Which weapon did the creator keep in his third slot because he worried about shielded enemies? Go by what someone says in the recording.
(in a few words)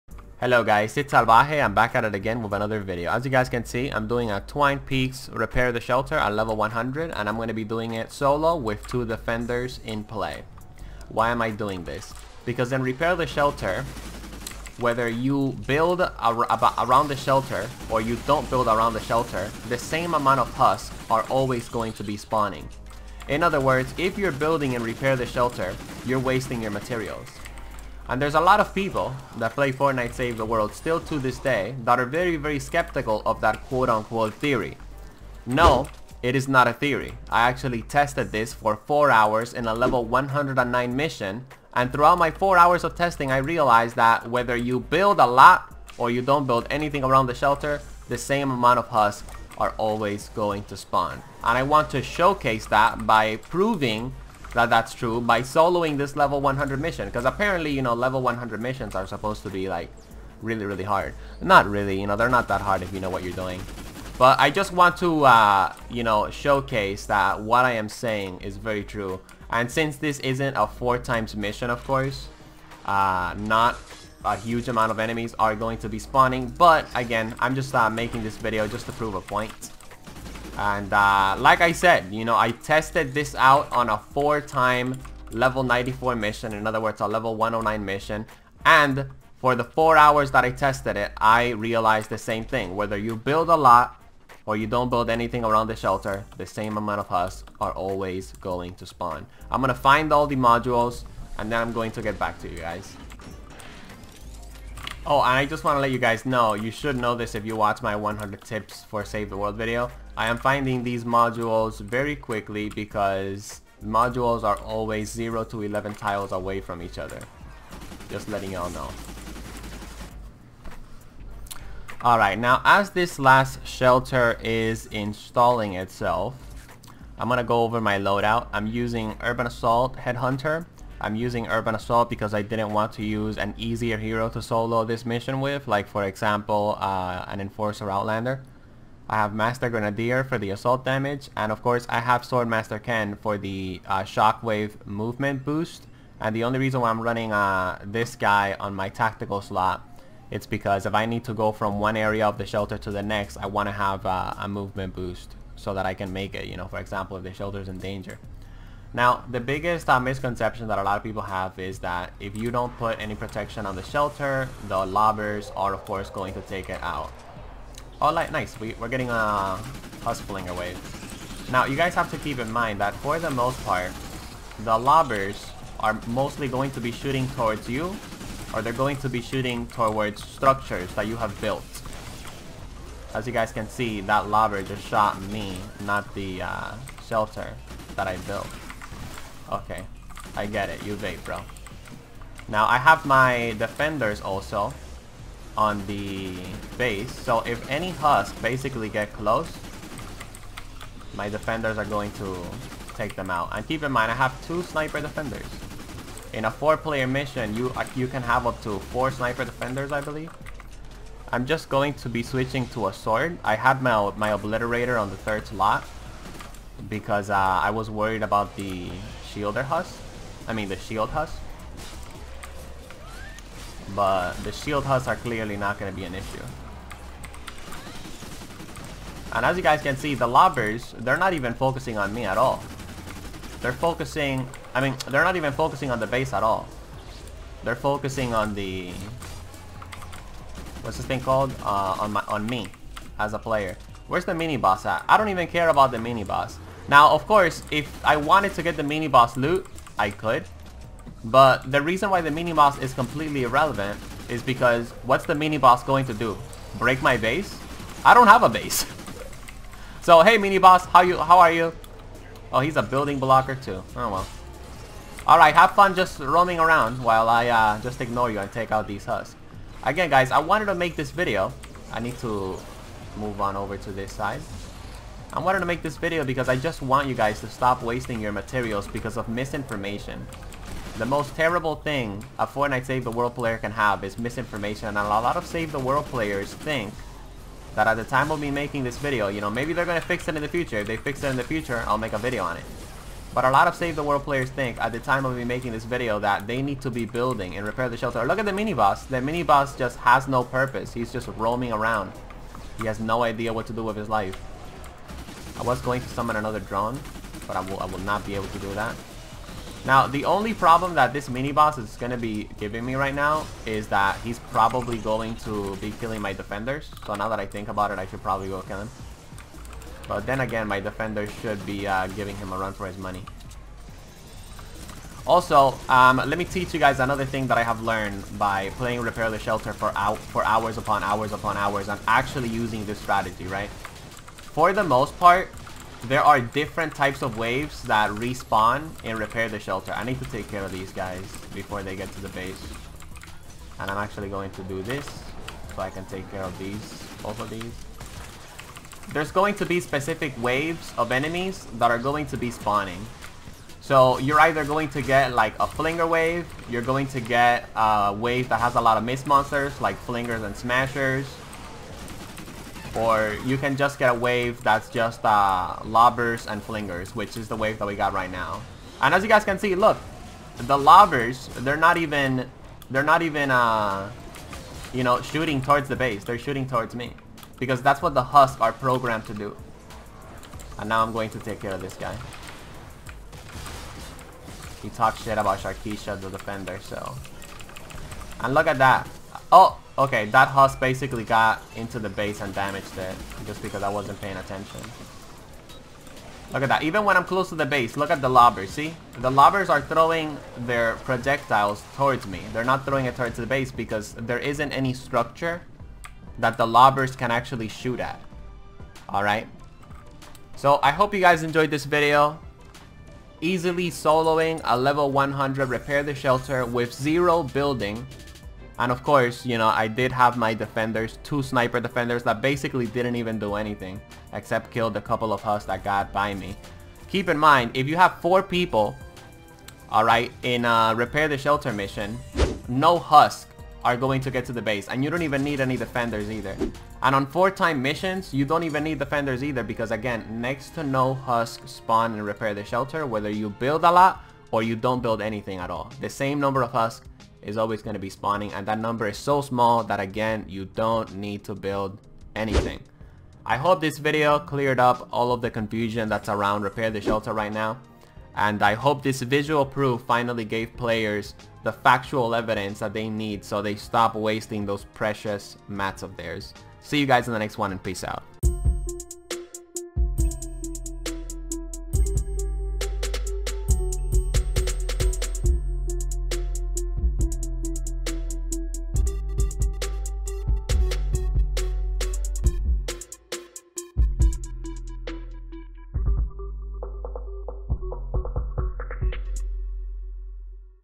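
obliterator.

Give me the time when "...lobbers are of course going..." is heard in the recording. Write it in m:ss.
2:44.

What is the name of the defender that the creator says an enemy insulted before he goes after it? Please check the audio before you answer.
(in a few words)
Sharkeisha.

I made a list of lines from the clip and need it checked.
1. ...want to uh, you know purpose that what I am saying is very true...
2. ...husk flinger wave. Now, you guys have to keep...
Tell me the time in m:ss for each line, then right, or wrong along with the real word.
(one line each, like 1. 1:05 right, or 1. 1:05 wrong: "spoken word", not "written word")
1. 1:04 wrong: "showcase", not "purpose"
2. 2:50 right.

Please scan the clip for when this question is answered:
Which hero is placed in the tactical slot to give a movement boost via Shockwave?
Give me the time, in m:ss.
2:22.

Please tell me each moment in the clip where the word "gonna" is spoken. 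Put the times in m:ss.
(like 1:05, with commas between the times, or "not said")
2:07, 4:49.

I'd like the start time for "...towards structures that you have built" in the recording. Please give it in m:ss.
2:59.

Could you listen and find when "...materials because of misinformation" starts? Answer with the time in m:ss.
4:38.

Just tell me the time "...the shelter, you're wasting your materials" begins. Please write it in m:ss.
0:25.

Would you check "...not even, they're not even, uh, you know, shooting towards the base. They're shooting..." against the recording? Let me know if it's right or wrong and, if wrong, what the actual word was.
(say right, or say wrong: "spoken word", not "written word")
right.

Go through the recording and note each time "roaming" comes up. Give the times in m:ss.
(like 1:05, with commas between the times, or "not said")
4:26, 5:01.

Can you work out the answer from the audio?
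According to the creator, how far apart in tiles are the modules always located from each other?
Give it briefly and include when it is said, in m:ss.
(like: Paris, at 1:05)
0 to 11, at 1:55.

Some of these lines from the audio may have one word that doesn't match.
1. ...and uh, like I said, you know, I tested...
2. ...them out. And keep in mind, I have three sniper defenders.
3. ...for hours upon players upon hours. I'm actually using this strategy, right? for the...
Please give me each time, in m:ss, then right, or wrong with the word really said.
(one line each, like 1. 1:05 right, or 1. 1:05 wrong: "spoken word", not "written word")
1. 1:20 right
2. 3:23 wrong: "two", not "three"
3. 5:30 wrong: "hours", not "players".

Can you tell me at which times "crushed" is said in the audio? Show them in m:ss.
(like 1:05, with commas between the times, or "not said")
not said.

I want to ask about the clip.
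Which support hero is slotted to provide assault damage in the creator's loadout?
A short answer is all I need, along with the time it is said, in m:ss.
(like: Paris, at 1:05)
Master Grenadier, at 2:19.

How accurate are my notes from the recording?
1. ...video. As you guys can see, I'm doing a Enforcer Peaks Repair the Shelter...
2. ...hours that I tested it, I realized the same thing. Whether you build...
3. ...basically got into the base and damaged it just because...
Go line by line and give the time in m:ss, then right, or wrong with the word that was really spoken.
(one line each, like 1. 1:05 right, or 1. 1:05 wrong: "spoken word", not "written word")
1. 0:02 wrong: "Twine", not "Enforcer"
2. 1:29 right
3. 6:30 right.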